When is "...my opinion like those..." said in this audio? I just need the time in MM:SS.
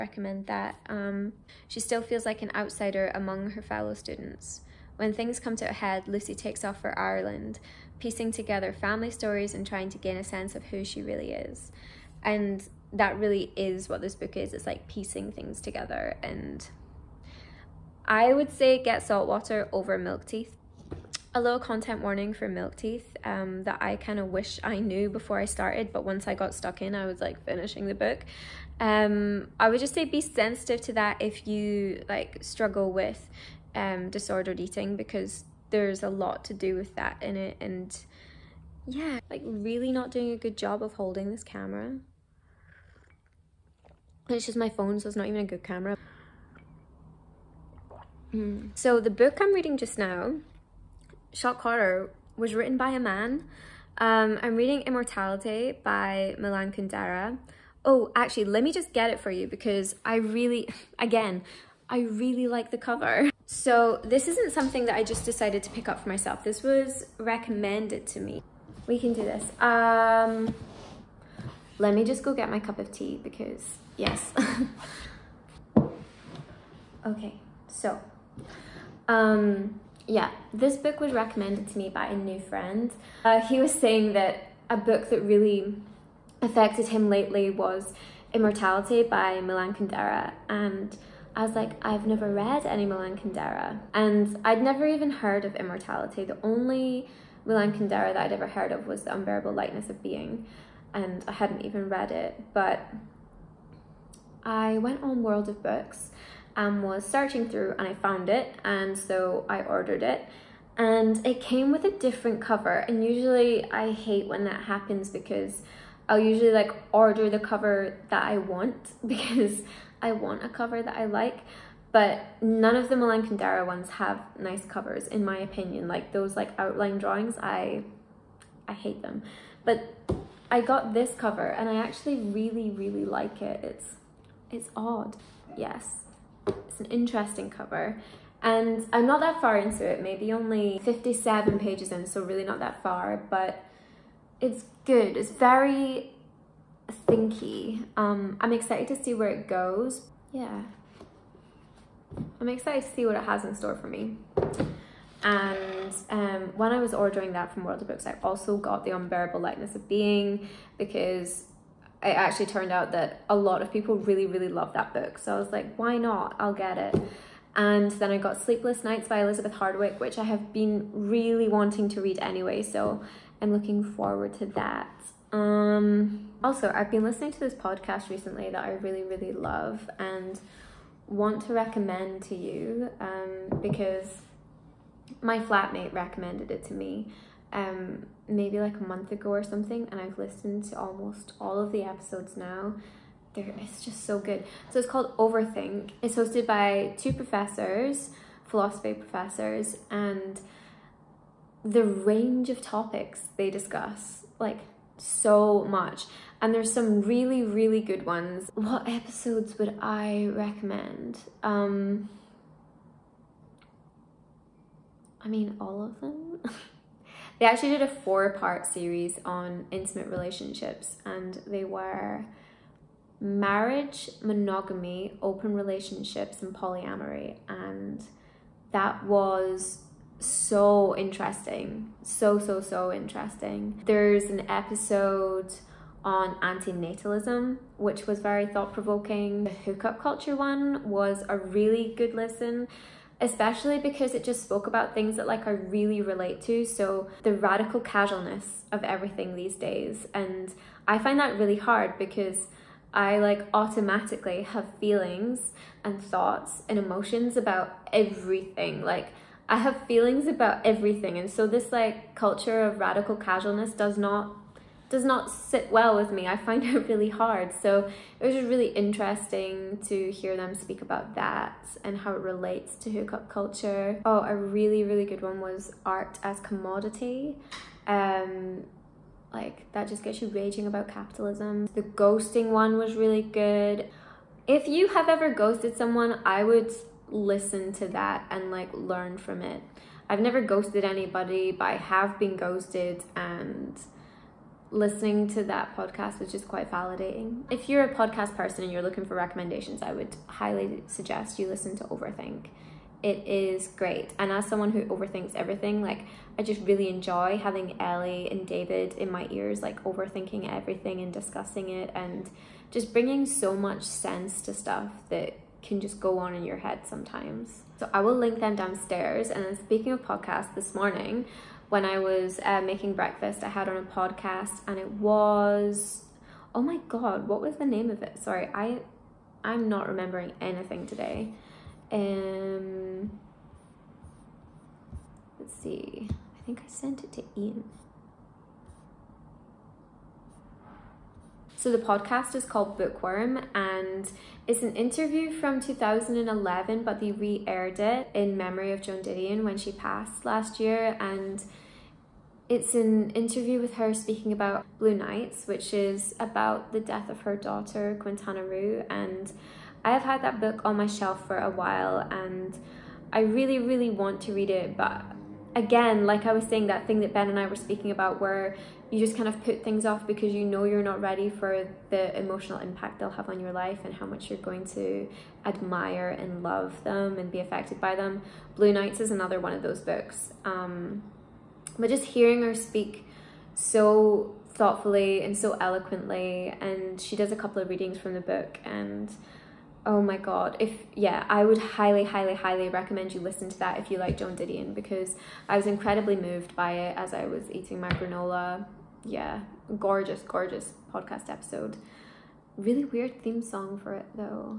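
02:05.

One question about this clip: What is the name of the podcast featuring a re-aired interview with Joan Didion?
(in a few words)
Bookworm.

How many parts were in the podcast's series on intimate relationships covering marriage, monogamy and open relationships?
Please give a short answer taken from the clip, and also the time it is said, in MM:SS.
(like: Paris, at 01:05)
4, at 03:37.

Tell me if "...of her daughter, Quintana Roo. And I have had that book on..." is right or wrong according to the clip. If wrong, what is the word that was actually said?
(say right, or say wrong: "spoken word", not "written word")
right.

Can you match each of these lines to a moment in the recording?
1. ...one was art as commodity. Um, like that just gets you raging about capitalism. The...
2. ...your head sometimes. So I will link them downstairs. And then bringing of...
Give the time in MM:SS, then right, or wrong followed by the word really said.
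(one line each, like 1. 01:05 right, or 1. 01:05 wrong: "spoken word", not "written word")
1. 04:35 right
2. 05:16 wrong: "speaking", not "bringing".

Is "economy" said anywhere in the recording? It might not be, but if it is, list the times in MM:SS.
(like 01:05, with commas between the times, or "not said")
not said.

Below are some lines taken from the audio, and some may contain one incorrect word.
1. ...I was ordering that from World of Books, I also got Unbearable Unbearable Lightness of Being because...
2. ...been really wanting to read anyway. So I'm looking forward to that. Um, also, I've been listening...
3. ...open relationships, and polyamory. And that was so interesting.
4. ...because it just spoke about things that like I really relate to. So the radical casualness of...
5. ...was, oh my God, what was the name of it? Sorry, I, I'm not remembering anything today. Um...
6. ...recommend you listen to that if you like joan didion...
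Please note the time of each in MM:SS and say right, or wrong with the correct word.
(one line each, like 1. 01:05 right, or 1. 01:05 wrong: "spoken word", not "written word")
1. 02:36 wrong: "The", not "Unbearable"
2. 02:50 right
3. 03:45 right
4. 04:03 right
5. 05:24 right
6. 06:32 right.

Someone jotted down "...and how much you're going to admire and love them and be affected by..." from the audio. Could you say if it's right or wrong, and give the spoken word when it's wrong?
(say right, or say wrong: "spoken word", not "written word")
right.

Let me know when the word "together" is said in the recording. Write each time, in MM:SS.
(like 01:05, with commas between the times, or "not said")
00:08, 00:15.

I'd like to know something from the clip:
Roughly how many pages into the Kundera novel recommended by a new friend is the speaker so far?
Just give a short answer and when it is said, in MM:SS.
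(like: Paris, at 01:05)
57, at 02:20.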